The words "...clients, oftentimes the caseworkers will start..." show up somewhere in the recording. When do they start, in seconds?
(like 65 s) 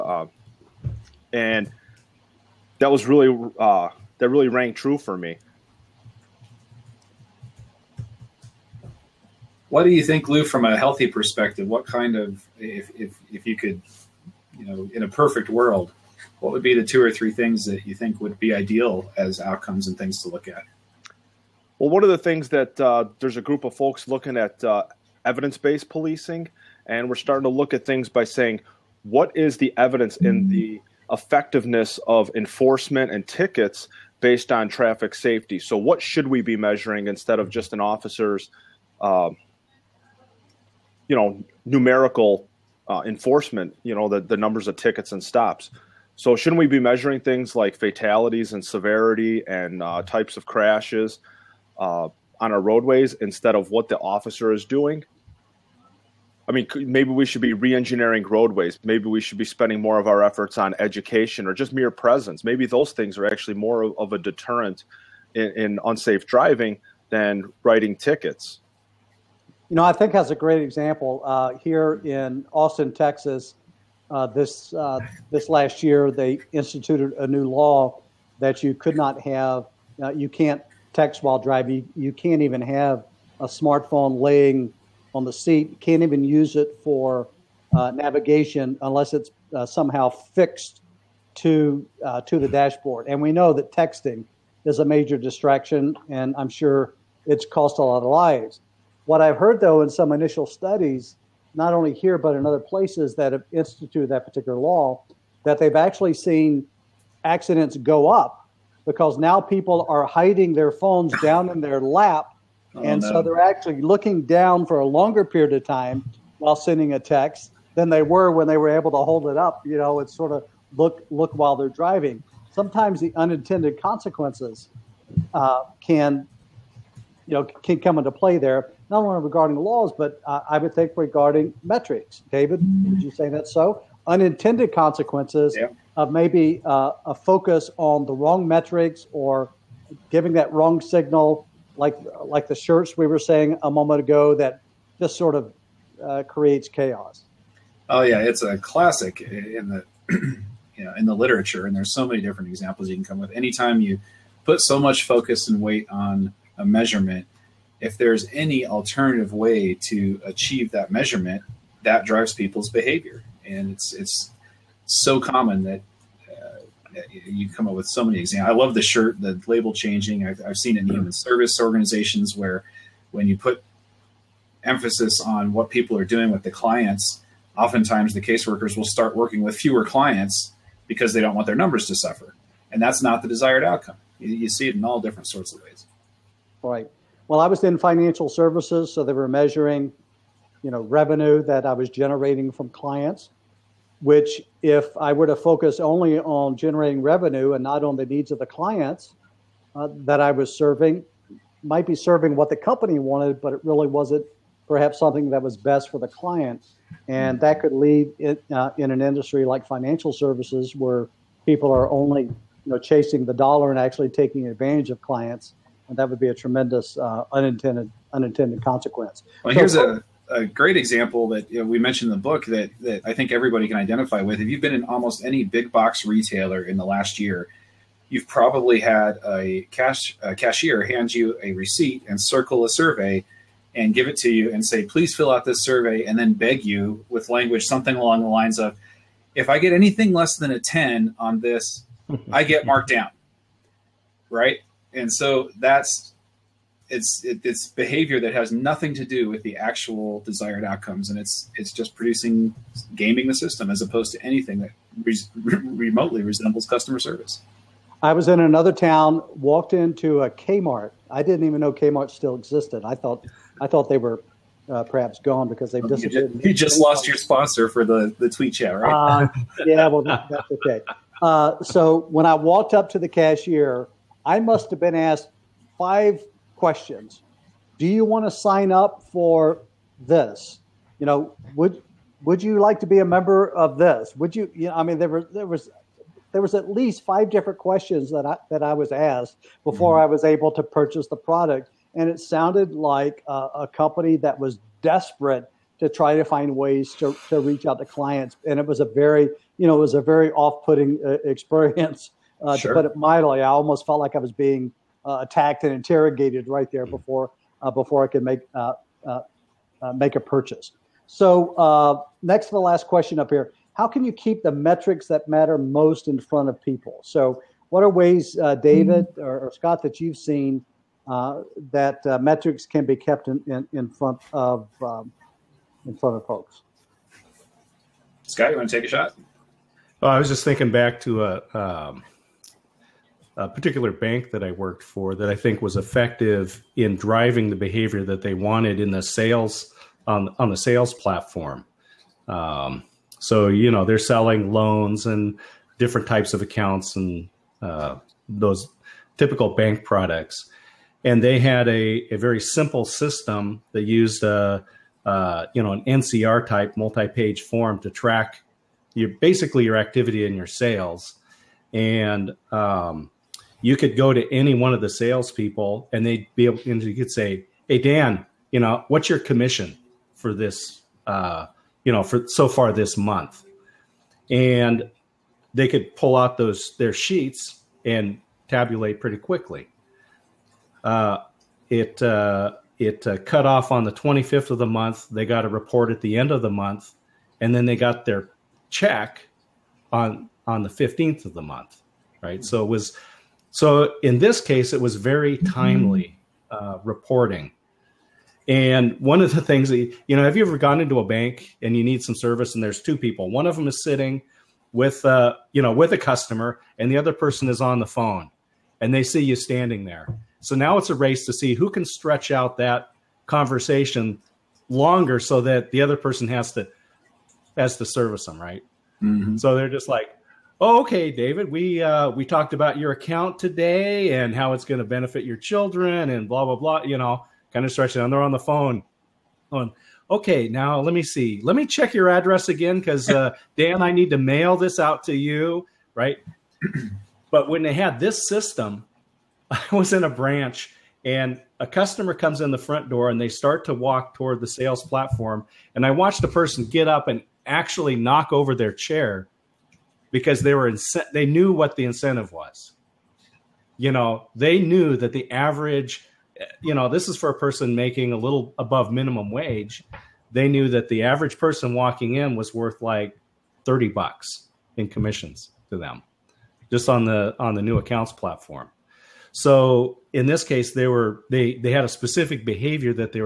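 176 s.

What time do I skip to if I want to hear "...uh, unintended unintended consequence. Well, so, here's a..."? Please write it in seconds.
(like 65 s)
216 s.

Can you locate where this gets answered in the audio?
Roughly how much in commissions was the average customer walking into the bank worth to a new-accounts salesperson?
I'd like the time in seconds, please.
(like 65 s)
463 s.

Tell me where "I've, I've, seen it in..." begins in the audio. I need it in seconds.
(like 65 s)
170 s.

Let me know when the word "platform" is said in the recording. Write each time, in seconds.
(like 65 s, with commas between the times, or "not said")
340 s, 444 s, 468 s.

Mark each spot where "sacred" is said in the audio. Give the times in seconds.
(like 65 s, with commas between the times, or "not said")
not said.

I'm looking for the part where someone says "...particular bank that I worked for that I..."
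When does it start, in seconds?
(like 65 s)
333 s.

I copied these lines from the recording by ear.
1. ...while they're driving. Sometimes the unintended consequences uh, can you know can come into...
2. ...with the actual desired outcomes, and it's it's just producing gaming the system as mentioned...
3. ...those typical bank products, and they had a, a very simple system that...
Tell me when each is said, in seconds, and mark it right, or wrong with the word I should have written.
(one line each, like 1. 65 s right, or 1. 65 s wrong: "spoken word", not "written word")
1. 121 s right
2. 249 s wrong: "opposed", not "mentioned"
3. 348 s right.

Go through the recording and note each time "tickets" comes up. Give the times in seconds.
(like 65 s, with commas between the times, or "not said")
33 s, 44 s, 67 s.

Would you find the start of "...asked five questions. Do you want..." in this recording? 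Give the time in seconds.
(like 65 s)
274 s.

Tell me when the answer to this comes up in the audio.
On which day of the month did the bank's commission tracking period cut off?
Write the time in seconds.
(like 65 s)
383 s.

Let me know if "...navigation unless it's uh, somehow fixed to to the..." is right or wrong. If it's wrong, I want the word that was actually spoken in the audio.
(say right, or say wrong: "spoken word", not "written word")
right.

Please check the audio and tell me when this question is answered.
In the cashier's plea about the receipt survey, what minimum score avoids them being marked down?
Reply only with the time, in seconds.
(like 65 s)
240 s.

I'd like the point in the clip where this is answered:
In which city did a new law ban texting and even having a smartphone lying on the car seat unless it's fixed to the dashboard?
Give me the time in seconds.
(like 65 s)
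72 s.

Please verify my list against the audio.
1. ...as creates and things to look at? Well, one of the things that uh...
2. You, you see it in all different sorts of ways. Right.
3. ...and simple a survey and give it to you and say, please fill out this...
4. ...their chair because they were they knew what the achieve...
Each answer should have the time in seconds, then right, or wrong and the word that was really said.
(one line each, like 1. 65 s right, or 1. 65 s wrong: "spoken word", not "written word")
1. 19 s wrong: "outcomes", not "creates"
2. 184 s right
3. 232 s wrong: "circle", not "simple"
4. 448 s wrong: "incentive", not "achieve".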